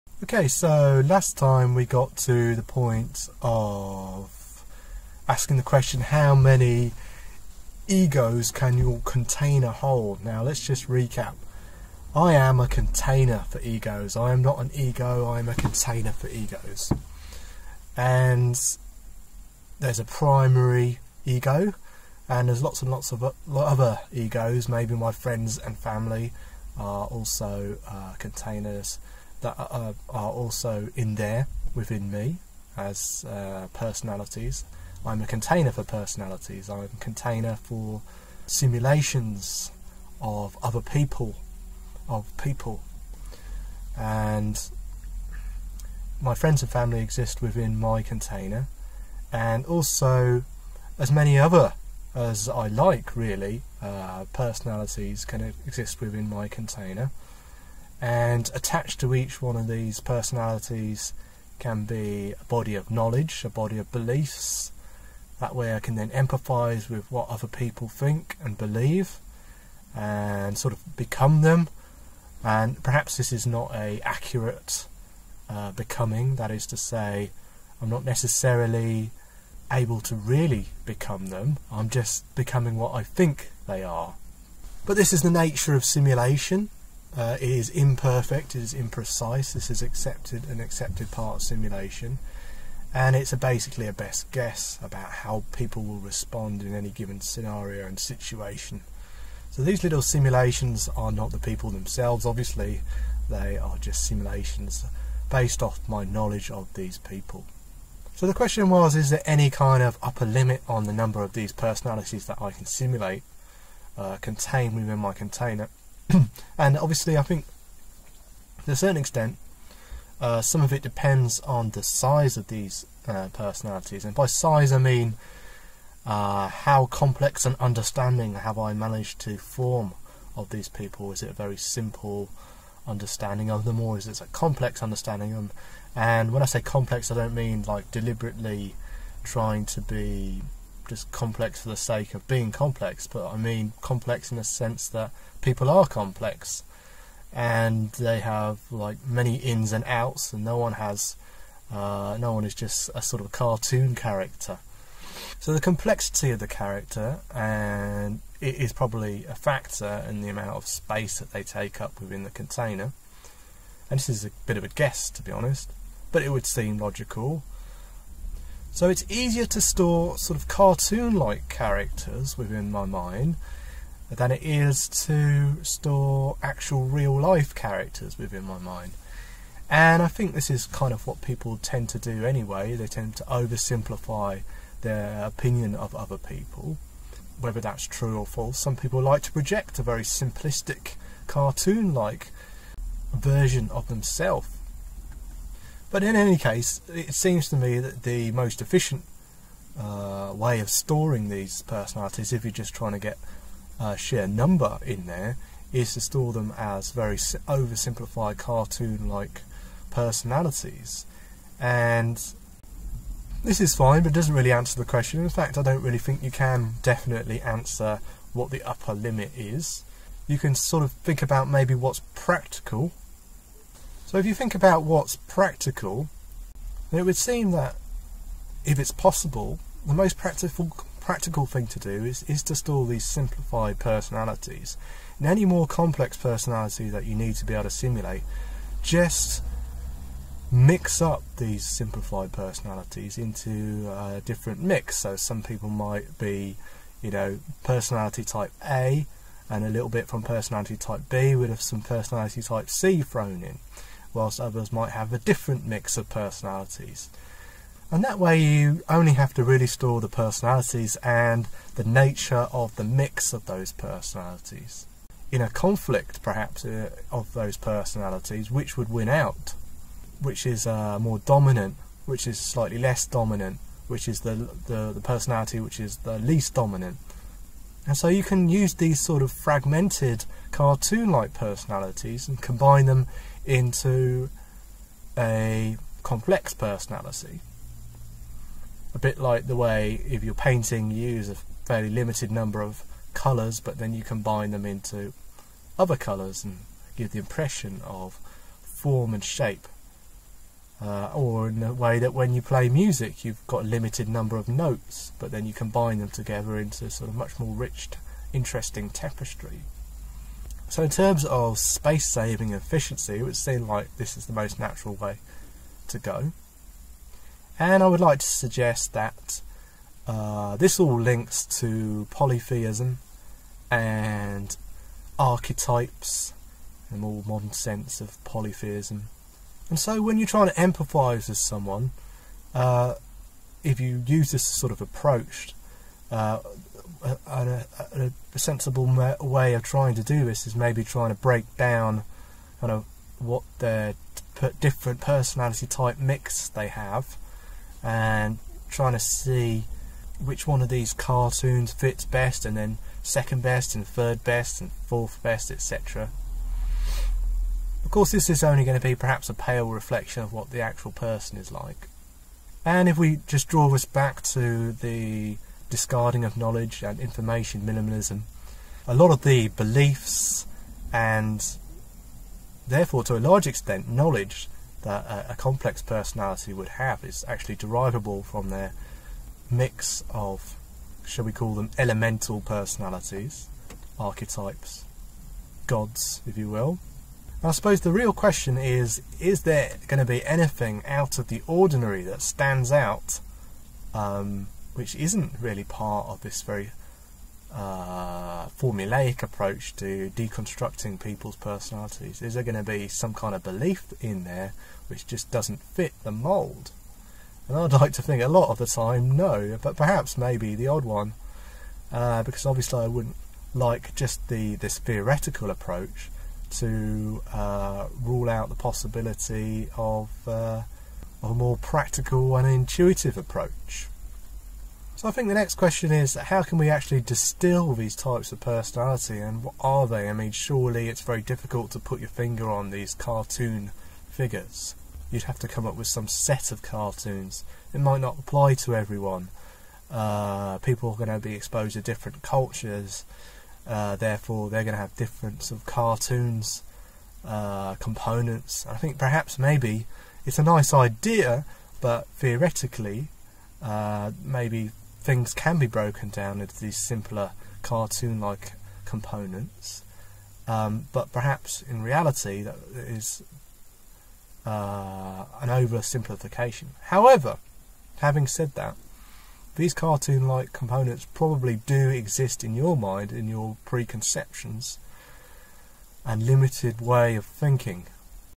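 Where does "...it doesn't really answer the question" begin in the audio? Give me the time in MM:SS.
03:34.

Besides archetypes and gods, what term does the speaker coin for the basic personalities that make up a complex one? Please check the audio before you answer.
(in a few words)
elemental personalities.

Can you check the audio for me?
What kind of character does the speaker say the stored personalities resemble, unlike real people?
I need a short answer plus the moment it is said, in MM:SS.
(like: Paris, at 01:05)
cartoon character, at 02:33.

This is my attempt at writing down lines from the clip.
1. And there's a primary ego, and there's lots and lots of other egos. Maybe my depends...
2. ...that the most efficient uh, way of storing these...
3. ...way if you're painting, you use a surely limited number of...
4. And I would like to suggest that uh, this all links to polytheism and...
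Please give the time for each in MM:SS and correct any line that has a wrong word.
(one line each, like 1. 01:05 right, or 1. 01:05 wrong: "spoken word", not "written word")
1. 00:17 wrong: "friends", not "depends"
2. 03:17 right
3. 04:49 wrong: "fairly", not "surely"
4. 05:17 right.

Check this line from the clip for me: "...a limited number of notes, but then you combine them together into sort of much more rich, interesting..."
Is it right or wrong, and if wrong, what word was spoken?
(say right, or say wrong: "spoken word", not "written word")
right.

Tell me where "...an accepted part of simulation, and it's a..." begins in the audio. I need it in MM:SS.
01:30.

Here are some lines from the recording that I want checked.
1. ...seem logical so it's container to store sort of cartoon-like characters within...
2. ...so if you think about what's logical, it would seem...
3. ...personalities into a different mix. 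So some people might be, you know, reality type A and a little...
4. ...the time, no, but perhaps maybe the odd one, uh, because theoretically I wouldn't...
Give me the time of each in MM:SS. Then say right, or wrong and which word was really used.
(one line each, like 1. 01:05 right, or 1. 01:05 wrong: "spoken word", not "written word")
1. 02:46 wrong: "easier", not "container"
2. 03:44 wrong: "practical", not "logical"
3. 04:02 wrong: "personality", not "reality"
4. 06:48 wrong: "obviously", not "theoretically".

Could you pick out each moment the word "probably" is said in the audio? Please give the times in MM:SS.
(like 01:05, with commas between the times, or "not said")
02:38, 07:51.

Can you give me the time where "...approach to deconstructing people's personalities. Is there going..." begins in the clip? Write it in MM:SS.
06:39.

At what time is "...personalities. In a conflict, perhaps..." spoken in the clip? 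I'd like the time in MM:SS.
04:23.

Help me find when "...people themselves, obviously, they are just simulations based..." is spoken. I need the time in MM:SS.
01:41.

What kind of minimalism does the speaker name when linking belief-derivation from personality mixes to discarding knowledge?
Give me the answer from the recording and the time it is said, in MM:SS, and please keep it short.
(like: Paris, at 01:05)
information minimalism, at 06:06.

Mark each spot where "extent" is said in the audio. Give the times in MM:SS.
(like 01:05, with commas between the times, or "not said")
01:58, 06:13.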